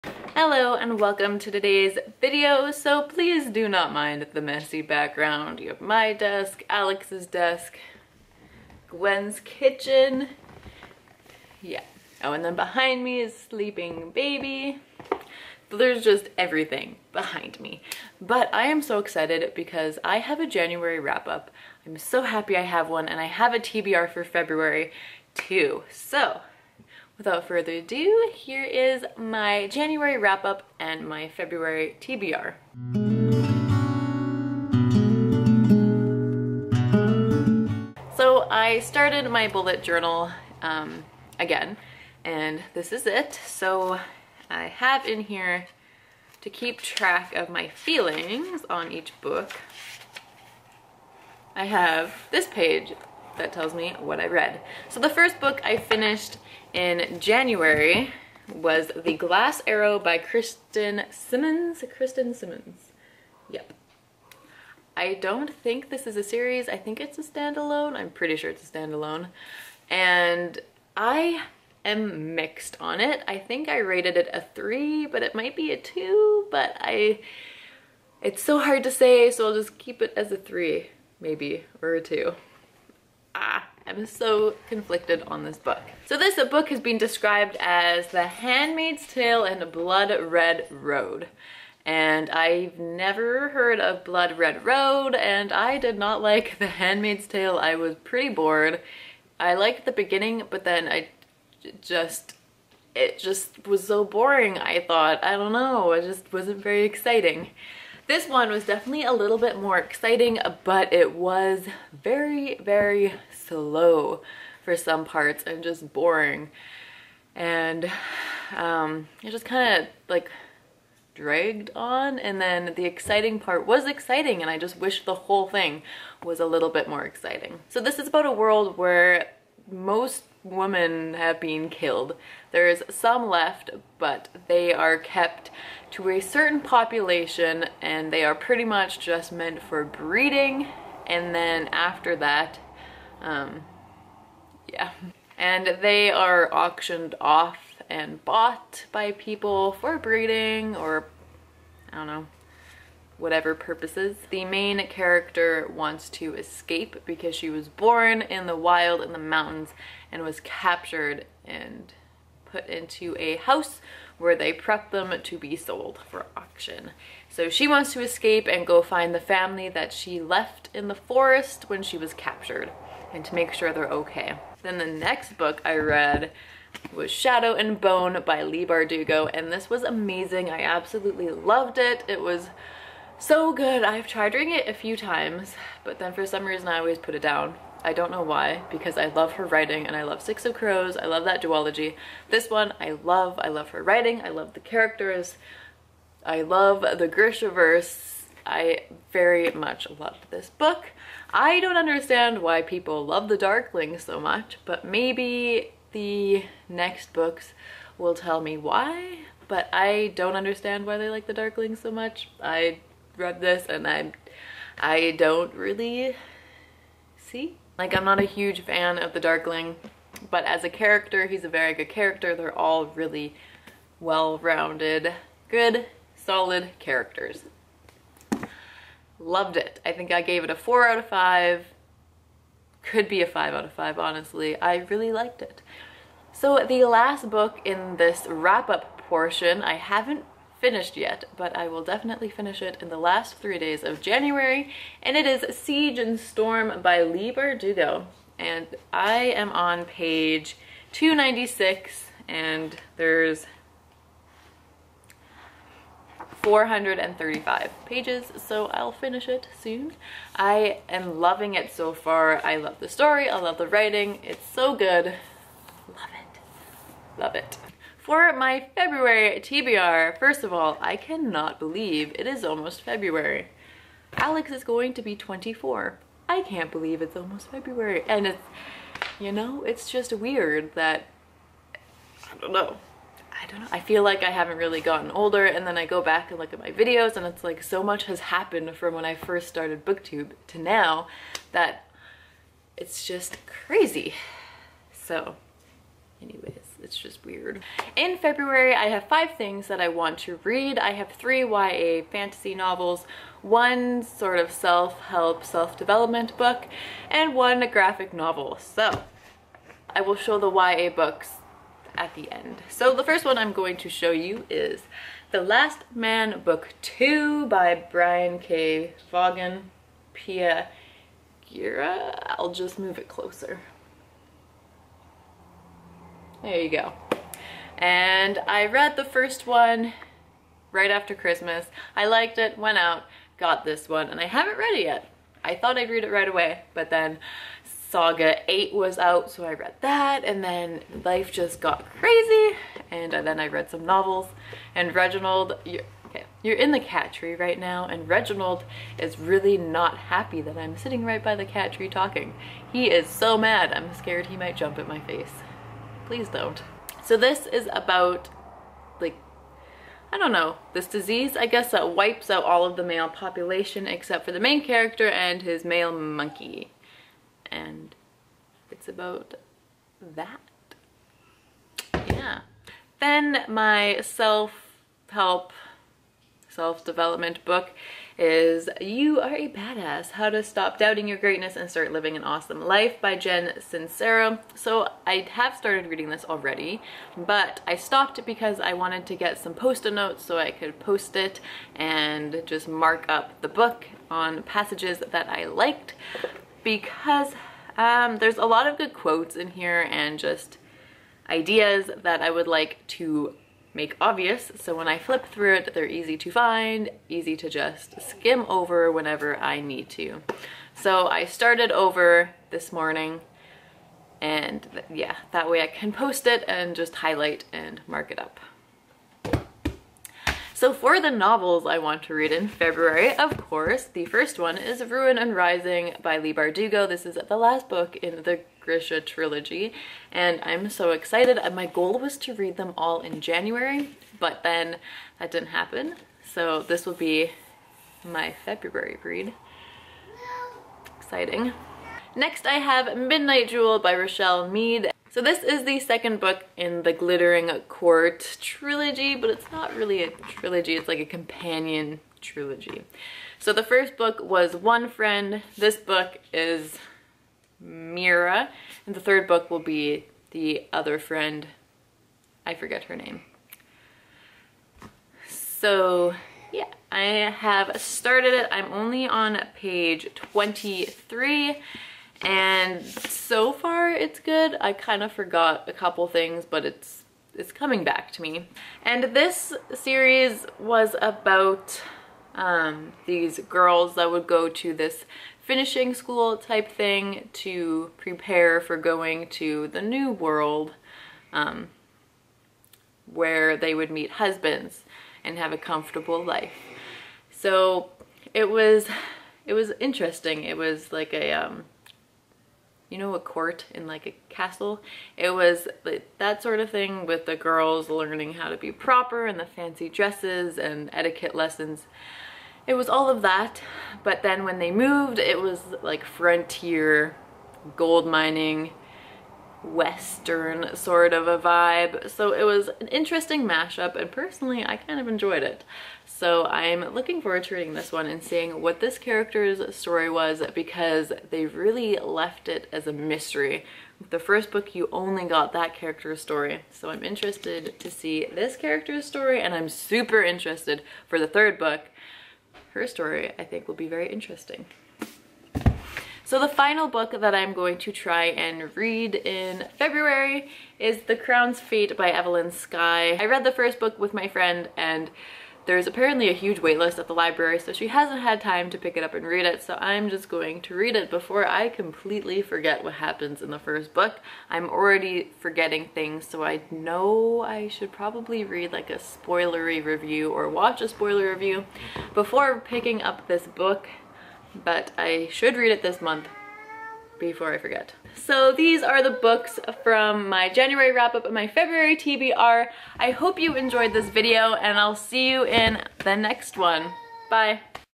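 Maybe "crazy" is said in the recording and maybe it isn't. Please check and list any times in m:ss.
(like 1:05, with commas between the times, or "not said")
4:53, 5:41.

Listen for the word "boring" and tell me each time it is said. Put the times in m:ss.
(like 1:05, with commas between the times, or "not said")
1:44, 1:55.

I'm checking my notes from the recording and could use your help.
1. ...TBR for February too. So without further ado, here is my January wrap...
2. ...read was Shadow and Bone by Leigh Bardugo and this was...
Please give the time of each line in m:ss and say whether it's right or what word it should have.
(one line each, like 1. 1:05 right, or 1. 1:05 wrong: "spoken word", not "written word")
1. 0:23 right
2. 2:55 right.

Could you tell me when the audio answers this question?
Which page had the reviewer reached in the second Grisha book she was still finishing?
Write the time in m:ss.
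4:10.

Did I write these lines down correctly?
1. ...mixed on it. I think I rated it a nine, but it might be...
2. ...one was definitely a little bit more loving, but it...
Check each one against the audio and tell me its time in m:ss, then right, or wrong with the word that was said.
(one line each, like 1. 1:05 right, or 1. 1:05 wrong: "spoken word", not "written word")
1. 1:12 wrong: "three", not "nine"
2. 1:48 wrong: "exciting", not "loving".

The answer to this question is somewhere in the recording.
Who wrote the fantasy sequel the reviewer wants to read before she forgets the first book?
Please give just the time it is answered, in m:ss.
9:12.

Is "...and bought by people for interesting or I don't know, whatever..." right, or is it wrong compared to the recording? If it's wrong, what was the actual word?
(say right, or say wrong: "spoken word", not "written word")
wrong: "breeding", not "interesting".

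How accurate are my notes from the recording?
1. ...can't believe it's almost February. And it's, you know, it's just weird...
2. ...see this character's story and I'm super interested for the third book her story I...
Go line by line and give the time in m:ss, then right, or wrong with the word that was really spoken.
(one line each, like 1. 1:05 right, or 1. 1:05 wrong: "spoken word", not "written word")
1. 4:36 right
2. 8:57 right.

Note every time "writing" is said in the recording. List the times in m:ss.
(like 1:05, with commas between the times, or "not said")
3:09, 3:13, 4:23.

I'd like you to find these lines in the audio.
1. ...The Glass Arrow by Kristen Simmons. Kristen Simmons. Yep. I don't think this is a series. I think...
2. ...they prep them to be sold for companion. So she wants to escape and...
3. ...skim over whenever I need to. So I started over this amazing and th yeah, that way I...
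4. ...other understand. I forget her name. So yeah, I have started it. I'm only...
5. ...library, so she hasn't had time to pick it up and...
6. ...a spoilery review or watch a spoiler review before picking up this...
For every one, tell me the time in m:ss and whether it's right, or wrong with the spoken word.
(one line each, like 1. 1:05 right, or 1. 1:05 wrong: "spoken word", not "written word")
1. 0:59 right
2. 2:44 wrong: "auction", not "companion"
3. 6:48 wrong: "morning", not "amazing"
4. 7:40 wrong: "friend", not "understand"
5. 9:17 right
6. 9:28 right.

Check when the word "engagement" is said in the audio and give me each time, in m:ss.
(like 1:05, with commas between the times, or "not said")
not said.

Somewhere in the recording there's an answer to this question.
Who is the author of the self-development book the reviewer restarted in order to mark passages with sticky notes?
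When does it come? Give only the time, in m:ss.
6:23.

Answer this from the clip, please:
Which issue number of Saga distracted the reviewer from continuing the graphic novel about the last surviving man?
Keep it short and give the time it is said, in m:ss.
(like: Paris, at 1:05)
8, at 5:37.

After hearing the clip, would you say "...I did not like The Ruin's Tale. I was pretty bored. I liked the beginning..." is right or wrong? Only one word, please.
wrong.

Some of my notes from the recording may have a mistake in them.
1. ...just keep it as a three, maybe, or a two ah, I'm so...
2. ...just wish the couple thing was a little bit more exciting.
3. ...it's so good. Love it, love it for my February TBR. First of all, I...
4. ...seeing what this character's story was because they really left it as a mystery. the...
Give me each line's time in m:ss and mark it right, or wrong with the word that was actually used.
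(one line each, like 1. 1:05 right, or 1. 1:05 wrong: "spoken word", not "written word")
1. 1:19 right
2. 2:04 wrong: "whole", not "couple"
3. 4:24 right
4. 8:48 right.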